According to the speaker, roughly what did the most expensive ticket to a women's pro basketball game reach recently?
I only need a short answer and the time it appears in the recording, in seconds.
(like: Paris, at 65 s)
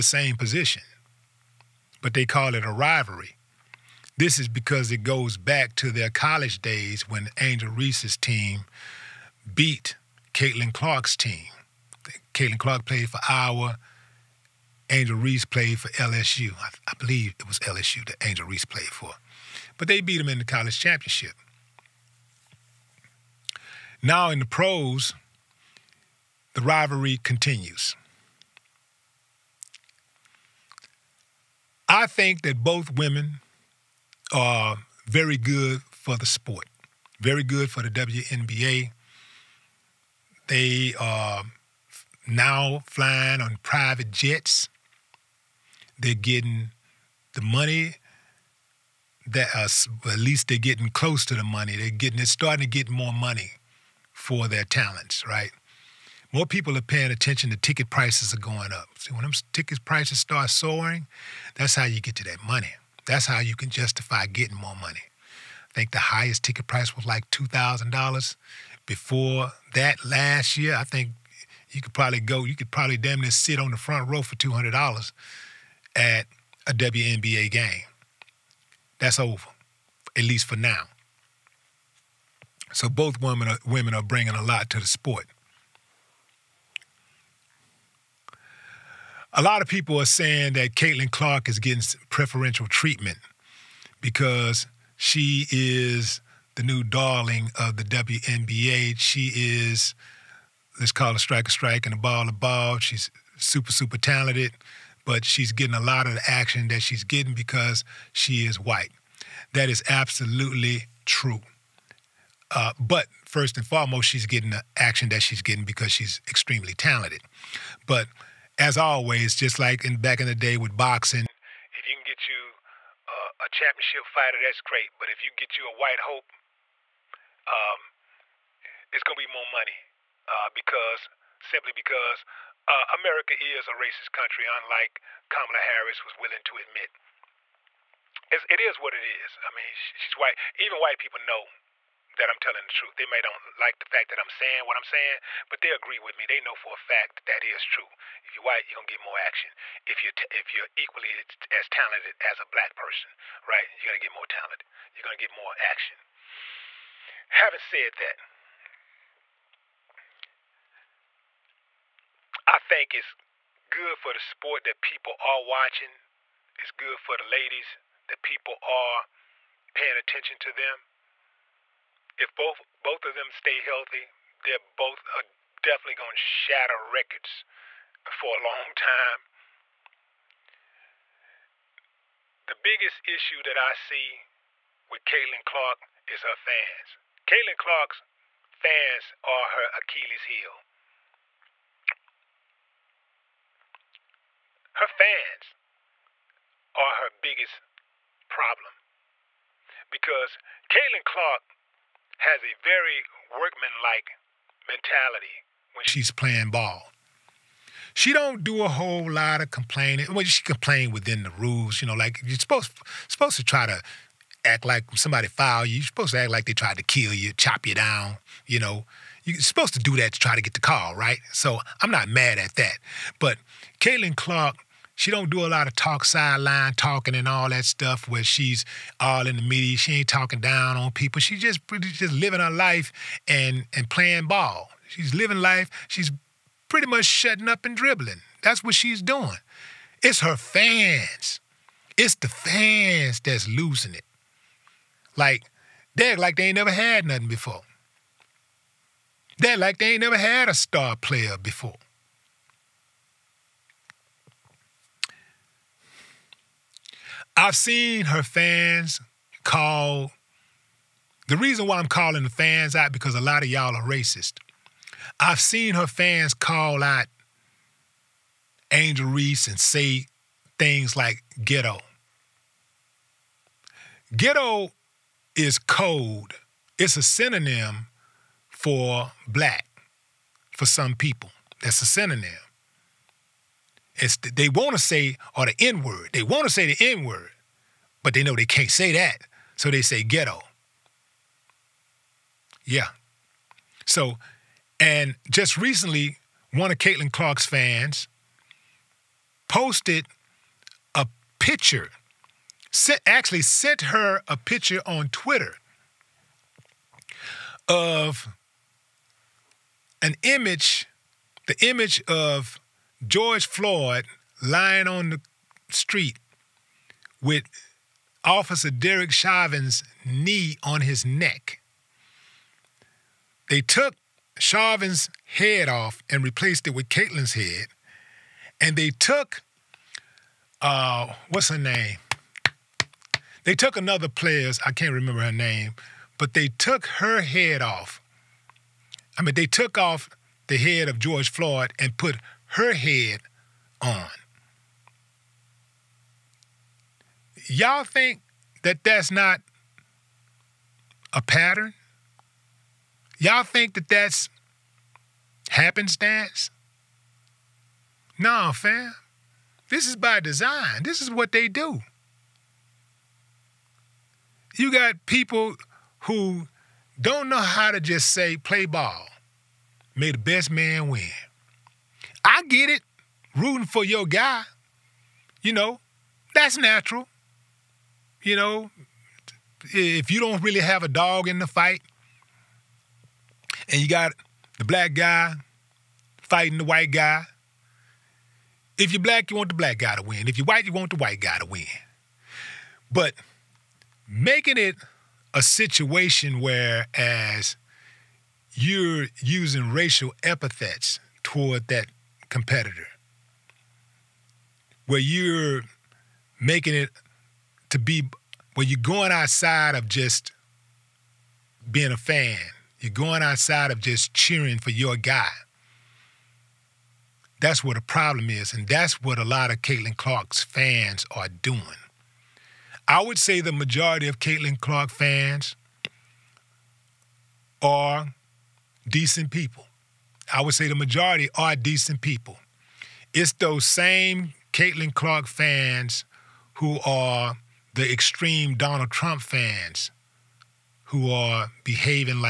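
$2,000, at 67 s.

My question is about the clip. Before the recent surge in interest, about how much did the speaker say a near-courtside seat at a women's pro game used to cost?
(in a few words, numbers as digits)
$200.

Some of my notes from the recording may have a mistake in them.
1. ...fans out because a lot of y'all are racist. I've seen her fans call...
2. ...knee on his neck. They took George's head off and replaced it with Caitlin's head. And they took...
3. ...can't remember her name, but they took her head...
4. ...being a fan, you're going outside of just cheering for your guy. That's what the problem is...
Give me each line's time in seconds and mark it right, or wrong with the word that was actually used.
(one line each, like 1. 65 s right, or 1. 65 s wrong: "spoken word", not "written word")
1. 262 s right
2. 320 s wrong: "Chauvin", not "George"
3. 334 s right
4. 411 s right.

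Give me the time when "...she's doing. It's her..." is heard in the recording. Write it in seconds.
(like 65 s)
238 s.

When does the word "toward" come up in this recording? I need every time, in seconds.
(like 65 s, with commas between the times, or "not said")
401 s.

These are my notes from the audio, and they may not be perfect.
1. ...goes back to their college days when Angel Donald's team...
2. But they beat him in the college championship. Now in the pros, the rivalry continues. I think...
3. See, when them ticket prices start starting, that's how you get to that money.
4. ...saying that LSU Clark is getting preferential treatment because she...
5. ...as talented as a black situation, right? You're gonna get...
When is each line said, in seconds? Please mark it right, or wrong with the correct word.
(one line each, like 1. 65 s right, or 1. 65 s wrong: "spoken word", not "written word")
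1. 5 s wrong: "Reese", not "Donald"
2. 19 s right
3. 58 s wrong: "soaring", not "starting"
4. 90 s wrong: "Caitlin", not "LSU"
5. 151 s wrong: "person", not "situation".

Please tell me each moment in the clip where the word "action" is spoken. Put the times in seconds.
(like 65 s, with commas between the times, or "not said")
106 s, 114 s, 149 s, 155 s.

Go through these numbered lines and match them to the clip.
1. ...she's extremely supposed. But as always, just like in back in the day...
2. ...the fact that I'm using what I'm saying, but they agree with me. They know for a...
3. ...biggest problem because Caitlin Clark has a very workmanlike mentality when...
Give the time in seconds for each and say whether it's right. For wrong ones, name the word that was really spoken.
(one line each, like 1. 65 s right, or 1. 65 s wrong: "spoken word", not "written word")
1. 115 s wrong: "talented", not "supposed"
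2. 143 s wrong: "saying", not "using"
3. 197 s right.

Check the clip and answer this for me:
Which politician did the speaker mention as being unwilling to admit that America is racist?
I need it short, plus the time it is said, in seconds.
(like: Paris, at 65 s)
Kamala Harris, at 135 s.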